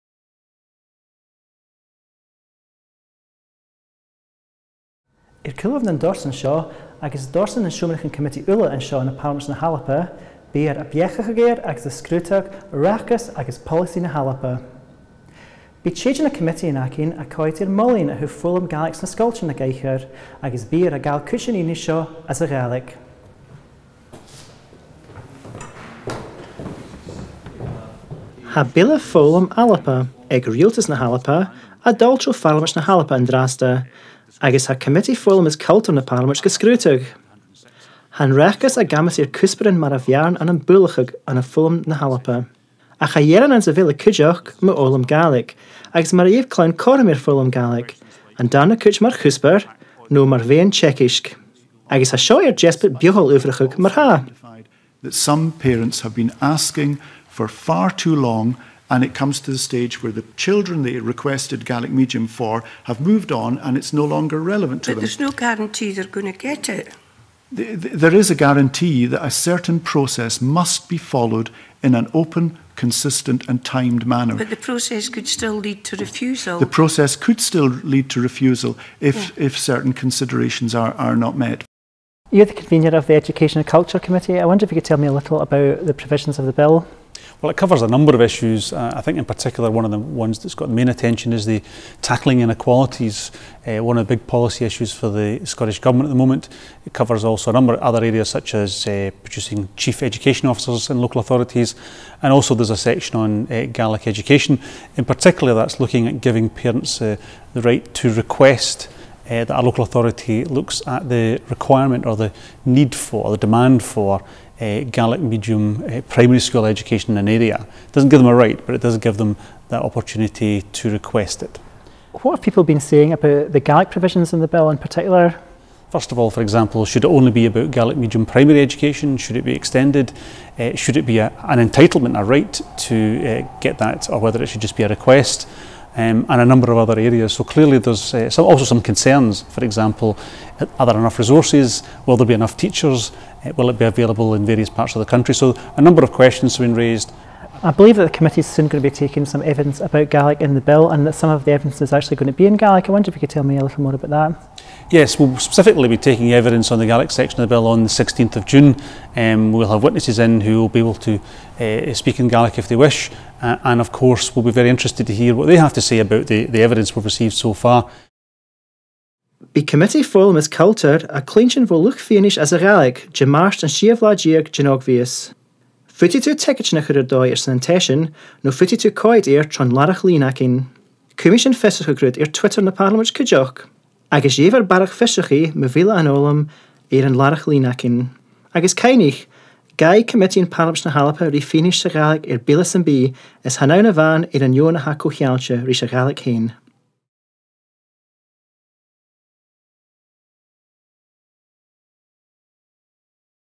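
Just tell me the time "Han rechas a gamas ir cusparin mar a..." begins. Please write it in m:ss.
0:38.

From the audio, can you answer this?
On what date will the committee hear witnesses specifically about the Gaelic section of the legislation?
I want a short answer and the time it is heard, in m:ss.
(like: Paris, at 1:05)
16 June, at 2:37.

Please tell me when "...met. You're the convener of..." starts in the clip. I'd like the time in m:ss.
1:21.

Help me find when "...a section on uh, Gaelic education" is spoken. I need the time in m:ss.
1:42.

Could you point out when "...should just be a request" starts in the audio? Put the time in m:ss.
2:14.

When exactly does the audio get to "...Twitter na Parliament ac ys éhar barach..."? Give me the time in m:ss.
3:02.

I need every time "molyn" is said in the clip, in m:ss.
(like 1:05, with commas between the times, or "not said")
0:17.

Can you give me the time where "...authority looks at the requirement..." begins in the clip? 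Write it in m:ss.
1:49.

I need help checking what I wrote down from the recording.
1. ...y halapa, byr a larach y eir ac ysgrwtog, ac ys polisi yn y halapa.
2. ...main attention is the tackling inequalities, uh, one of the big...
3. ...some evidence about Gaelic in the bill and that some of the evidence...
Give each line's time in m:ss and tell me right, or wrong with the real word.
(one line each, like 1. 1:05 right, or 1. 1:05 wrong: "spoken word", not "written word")
1. 0:09 wrong: "biechach", not "larach"
2. 1:30 right
3. 2:29 right.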